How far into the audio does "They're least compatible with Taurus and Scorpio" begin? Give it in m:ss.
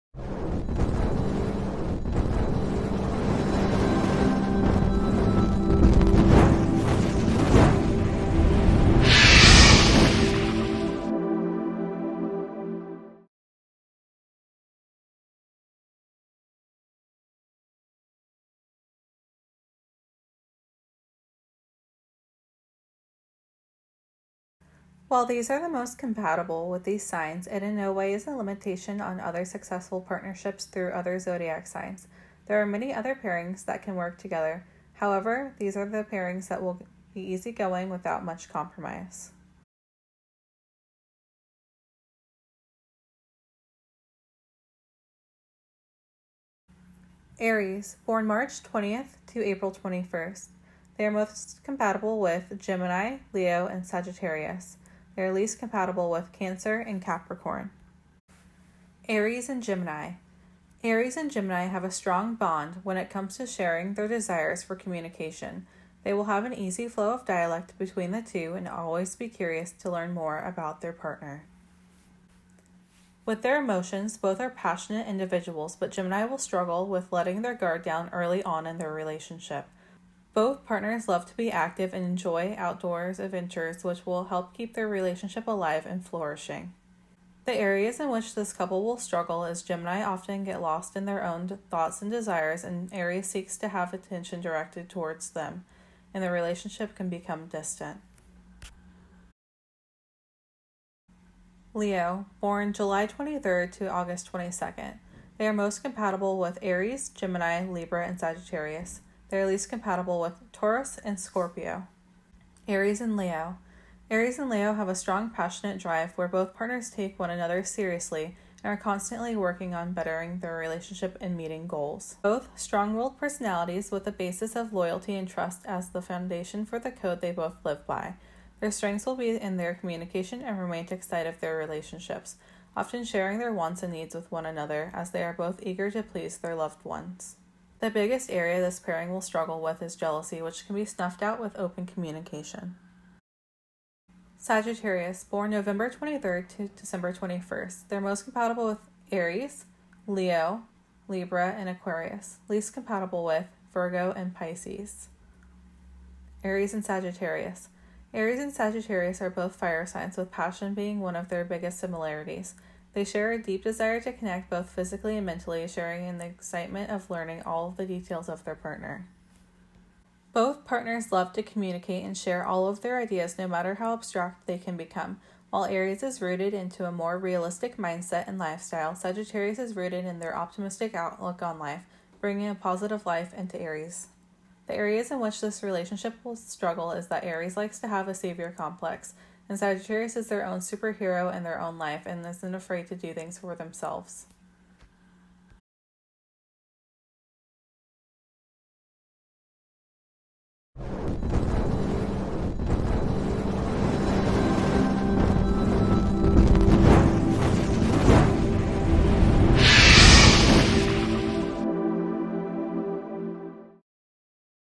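1:49.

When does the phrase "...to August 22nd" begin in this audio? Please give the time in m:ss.
1:43.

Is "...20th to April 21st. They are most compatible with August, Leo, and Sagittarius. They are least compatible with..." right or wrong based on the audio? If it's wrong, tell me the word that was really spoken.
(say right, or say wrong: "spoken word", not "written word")
wrong: "Gemini", not "August".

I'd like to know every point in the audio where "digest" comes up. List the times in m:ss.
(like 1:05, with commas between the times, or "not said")
not said.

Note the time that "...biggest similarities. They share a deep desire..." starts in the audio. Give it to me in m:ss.
2:41.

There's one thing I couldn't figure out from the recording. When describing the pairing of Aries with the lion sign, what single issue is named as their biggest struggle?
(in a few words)
jealousy.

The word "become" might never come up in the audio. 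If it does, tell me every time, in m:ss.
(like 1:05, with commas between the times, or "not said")
1:37, 2:54.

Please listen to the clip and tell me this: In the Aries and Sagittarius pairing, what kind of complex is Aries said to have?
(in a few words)
savior complex.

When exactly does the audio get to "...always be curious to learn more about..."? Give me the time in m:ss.
1:08.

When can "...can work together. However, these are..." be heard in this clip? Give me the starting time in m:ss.
0:33.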